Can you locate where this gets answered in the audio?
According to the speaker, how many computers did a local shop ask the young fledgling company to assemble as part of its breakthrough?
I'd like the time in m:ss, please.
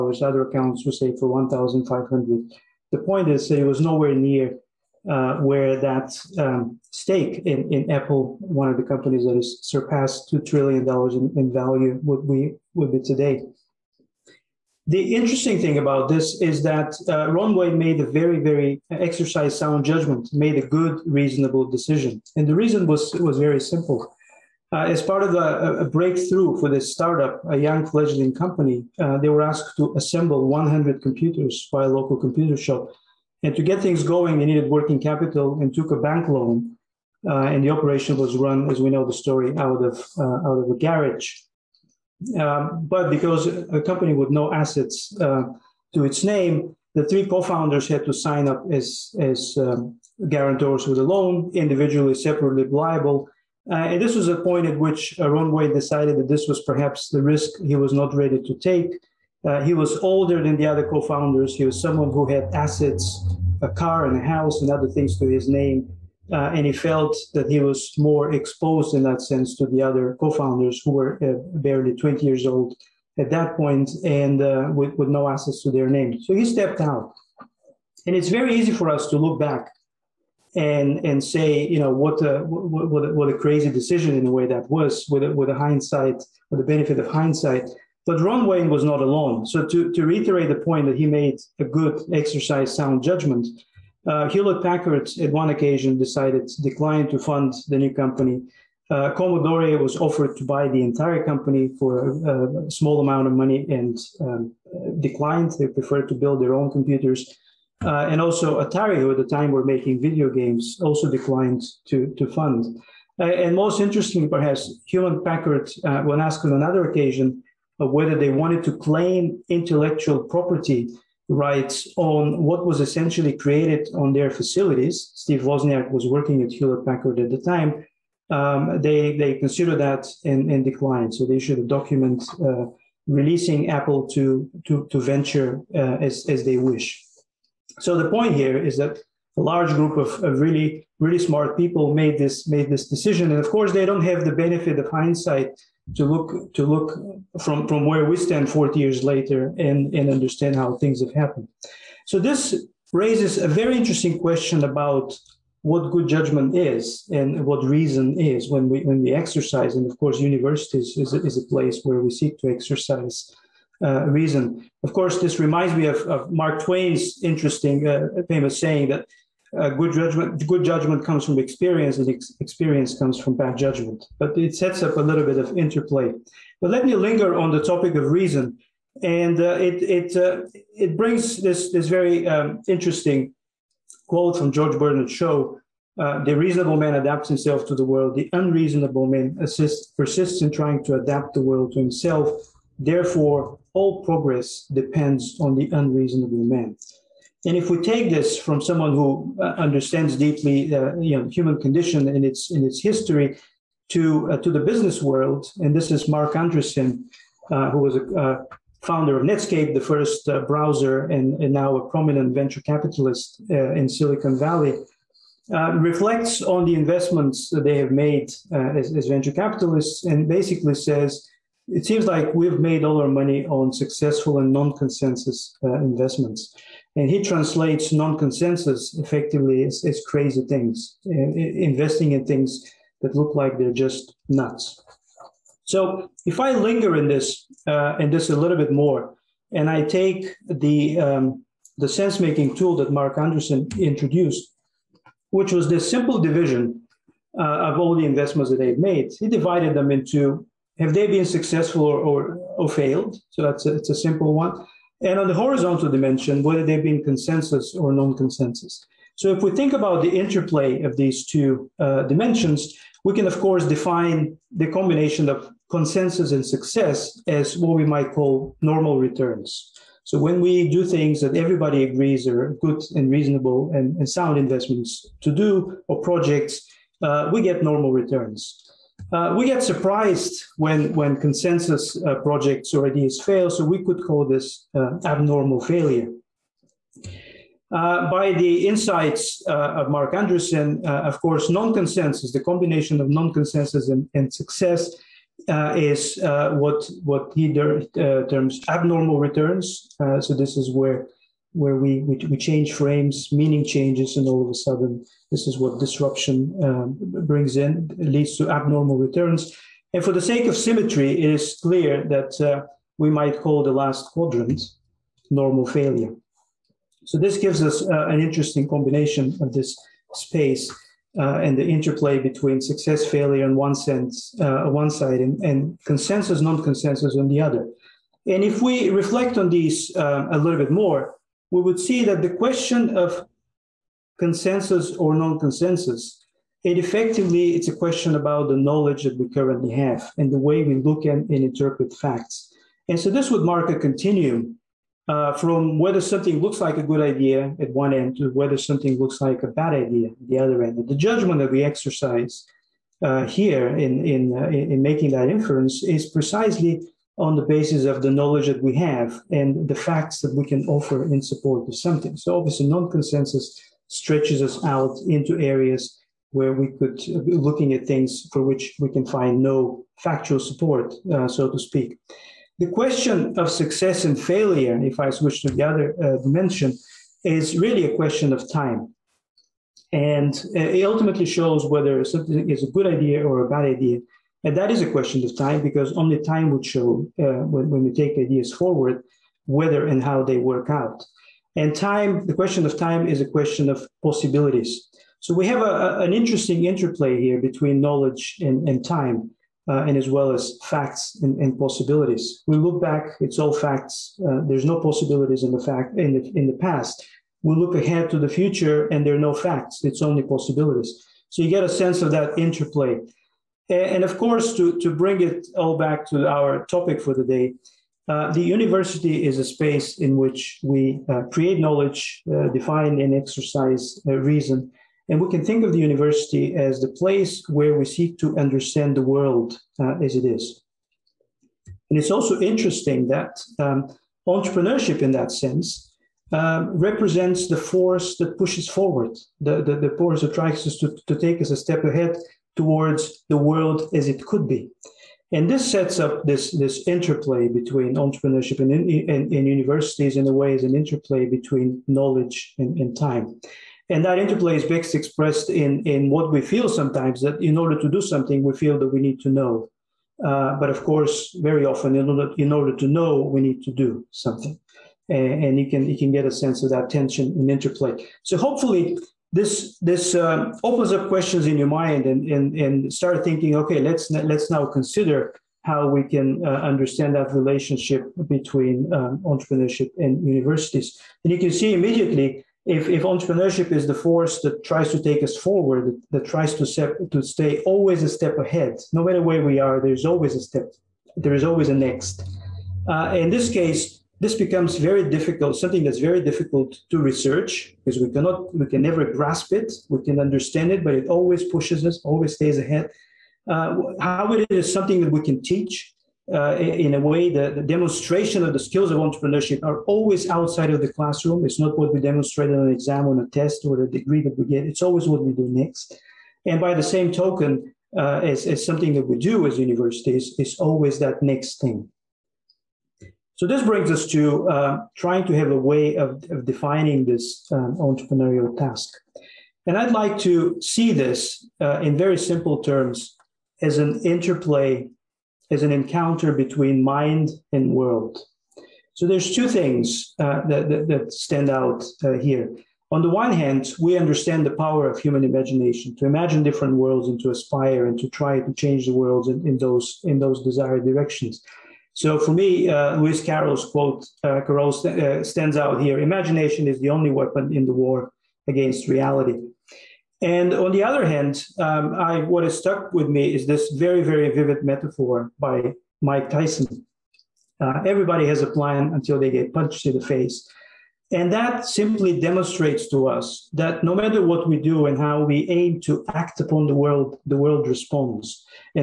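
0:30.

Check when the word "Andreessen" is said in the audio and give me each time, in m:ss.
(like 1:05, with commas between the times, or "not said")
3:26, 4:03, 4:50.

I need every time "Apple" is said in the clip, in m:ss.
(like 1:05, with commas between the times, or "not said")
0:07, 2:13.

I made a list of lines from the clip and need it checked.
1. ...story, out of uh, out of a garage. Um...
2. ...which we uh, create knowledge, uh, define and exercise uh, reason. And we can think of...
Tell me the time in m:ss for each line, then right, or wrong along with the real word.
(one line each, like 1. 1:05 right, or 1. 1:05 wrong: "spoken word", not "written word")
1. 0:39 right
2. 7:00 right.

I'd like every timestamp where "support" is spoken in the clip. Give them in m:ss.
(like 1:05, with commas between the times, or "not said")
6:01, 6:10.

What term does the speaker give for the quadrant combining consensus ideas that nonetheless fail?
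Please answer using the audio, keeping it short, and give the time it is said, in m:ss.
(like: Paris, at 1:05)
abnormal failure, at 4:45.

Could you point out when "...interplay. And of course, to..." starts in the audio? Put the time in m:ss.
6:52.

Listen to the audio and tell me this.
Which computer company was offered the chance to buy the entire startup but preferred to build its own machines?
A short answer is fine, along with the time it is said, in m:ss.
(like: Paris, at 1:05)
Commodore, at 1:39.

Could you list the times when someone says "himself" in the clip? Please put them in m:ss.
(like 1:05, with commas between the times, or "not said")
3:07, 3:11.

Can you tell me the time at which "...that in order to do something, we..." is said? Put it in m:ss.
7:37.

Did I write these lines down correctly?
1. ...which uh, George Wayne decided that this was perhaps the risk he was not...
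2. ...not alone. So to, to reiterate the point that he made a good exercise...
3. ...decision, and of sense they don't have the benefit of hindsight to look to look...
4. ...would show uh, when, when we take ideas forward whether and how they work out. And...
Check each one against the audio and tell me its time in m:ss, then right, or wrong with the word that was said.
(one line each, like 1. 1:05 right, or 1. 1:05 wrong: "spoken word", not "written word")
1. 0:54 wrong: "Ron", not "George"
2. 1:28 right
3. 2:22 wrong: "course", not "sense"
4. 6:26 right.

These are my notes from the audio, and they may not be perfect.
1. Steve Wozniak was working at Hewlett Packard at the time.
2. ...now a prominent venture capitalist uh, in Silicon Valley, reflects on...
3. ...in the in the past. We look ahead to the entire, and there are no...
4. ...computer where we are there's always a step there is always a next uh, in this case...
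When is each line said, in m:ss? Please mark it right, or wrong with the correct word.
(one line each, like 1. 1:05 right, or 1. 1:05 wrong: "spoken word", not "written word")
1. 2:05 right
2. 3:31 right
3. 6:45 wrong: "future", not "entire"
4. 8:09 wrong: "matter", not "computer".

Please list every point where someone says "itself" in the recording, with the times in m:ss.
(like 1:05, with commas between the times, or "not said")
not said.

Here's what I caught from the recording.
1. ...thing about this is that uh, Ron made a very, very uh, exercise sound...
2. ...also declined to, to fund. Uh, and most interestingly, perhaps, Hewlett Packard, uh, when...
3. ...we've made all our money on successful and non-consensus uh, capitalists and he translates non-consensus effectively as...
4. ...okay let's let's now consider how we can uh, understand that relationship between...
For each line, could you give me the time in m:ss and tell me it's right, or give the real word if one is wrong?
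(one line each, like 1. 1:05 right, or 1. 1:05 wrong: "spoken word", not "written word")
1. 0:15 right
2. 1:50 right
3. 3:42 wrong: "investments", not "capitalists"
4. 7:53 right.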